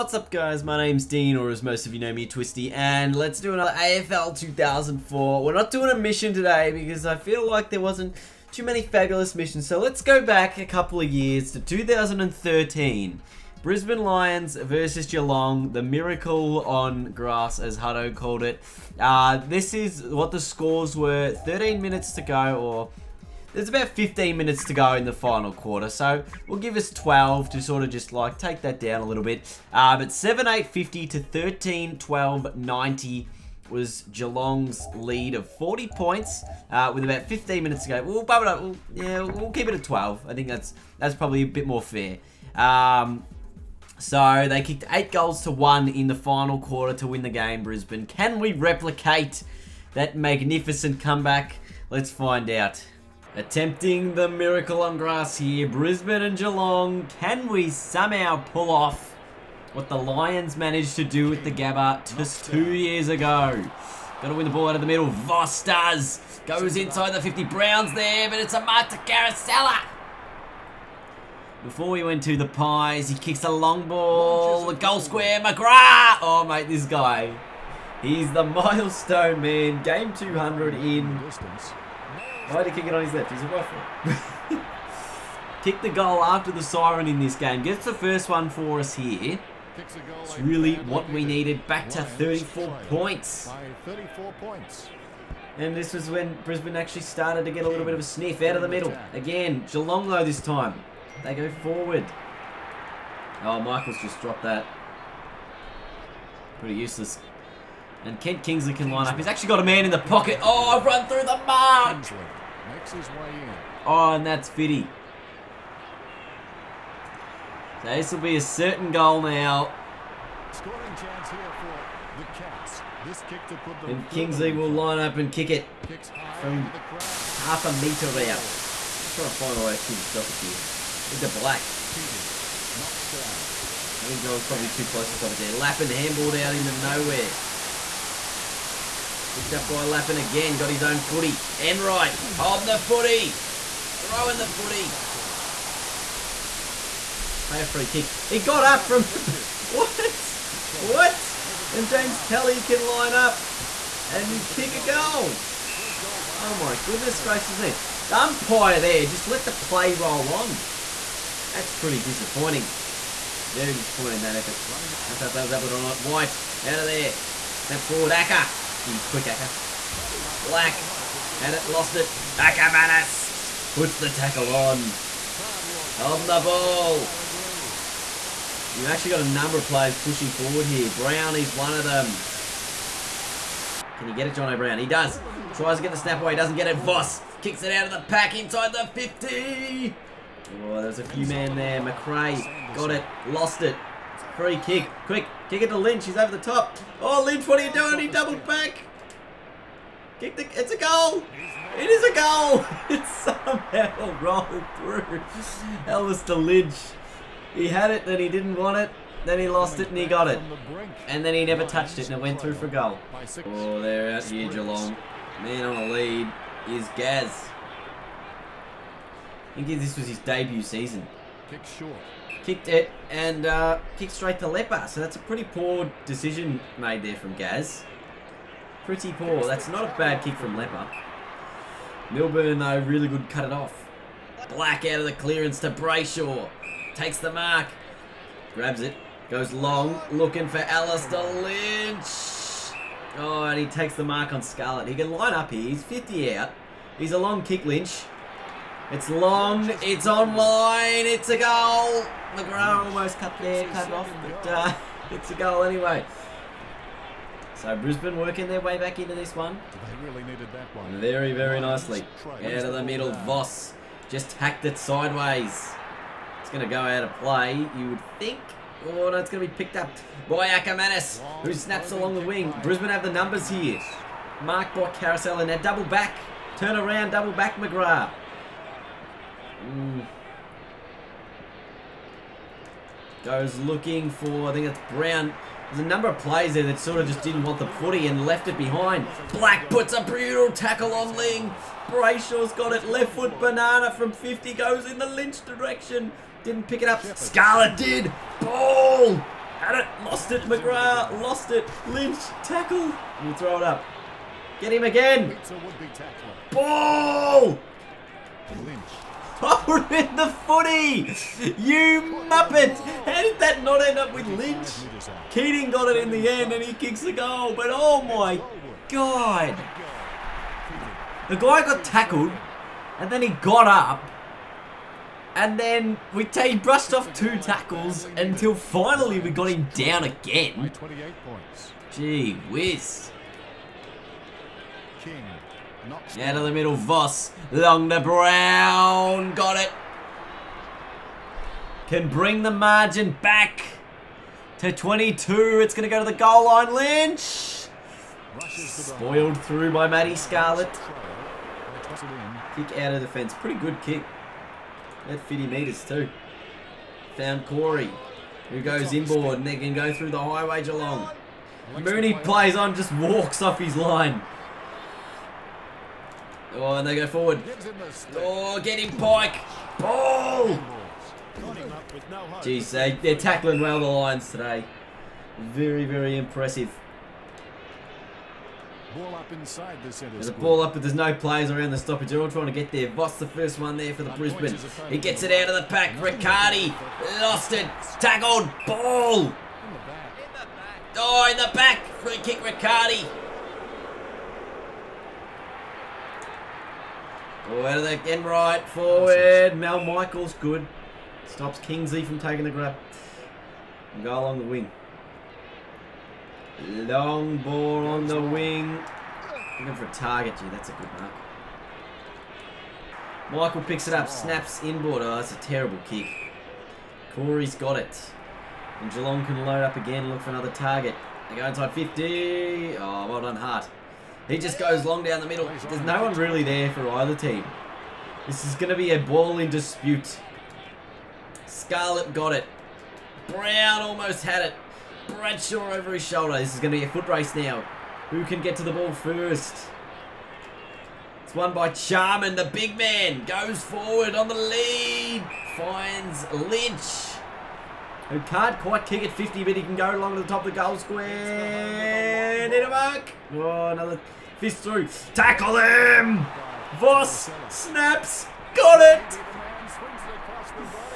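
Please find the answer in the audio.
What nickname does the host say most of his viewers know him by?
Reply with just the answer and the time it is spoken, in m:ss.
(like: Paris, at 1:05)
Twisty, at 0:02.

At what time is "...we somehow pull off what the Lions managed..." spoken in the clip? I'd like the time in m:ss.
0:57.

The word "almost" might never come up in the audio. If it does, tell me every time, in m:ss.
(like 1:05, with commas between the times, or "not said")
4:12, 7:13.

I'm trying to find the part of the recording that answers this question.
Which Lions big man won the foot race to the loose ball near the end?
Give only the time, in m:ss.
7:21.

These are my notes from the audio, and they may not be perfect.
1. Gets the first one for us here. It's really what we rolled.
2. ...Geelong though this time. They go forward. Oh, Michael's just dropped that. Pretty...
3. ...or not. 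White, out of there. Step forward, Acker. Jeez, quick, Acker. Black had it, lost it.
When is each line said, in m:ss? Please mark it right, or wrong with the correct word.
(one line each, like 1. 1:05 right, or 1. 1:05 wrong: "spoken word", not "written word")
1. 1:27 wrong: "needed", not "rolled"
2. 1:39 right
3. 2:45 right.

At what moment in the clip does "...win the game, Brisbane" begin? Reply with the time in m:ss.
0:47.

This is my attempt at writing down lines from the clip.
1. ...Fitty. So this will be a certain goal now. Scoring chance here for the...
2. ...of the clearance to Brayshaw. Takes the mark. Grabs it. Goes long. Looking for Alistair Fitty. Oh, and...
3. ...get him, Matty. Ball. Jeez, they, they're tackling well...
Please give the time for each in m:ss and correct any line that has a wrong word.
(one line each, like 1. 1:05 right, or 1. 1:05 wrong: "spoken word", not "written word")
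1. 1:54 right
2. 3:54 wrong: "Lynch", not "Fitty"
3. 6:08 wrong: "Pike", not "Matty".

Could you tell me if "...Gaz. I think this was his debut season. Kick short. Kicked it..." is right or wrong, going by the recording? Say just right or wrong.
right.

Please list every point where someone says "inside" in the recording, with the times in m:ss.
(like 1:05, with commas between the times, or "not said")
1:06, 3:08, 6:19, 7:01.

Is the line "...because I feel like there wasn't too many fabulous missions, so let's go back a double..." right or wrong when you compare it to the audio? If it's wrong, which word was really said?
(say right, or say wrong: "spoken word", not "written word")
wrong: "couple", not "double".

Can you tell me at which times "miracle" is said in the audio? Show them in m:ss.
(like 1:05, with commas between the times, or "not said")
0:15, 0:54.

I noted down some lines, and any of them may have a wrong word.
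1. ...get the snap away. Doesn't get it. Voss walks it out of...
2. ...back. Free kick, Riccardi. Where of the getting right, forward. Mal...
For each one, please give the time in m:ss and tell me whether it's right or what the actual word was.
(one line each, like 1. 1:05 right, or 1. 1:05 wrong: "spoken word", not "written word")
1. 3:05 wrong: "kicks", not "walks"
2. 6:31 right.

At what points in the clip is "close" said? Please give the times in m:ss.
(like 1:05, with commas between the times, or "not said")
2:14.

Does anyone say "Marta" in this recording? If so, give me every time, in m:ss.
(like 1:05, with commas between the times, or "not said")
1:08.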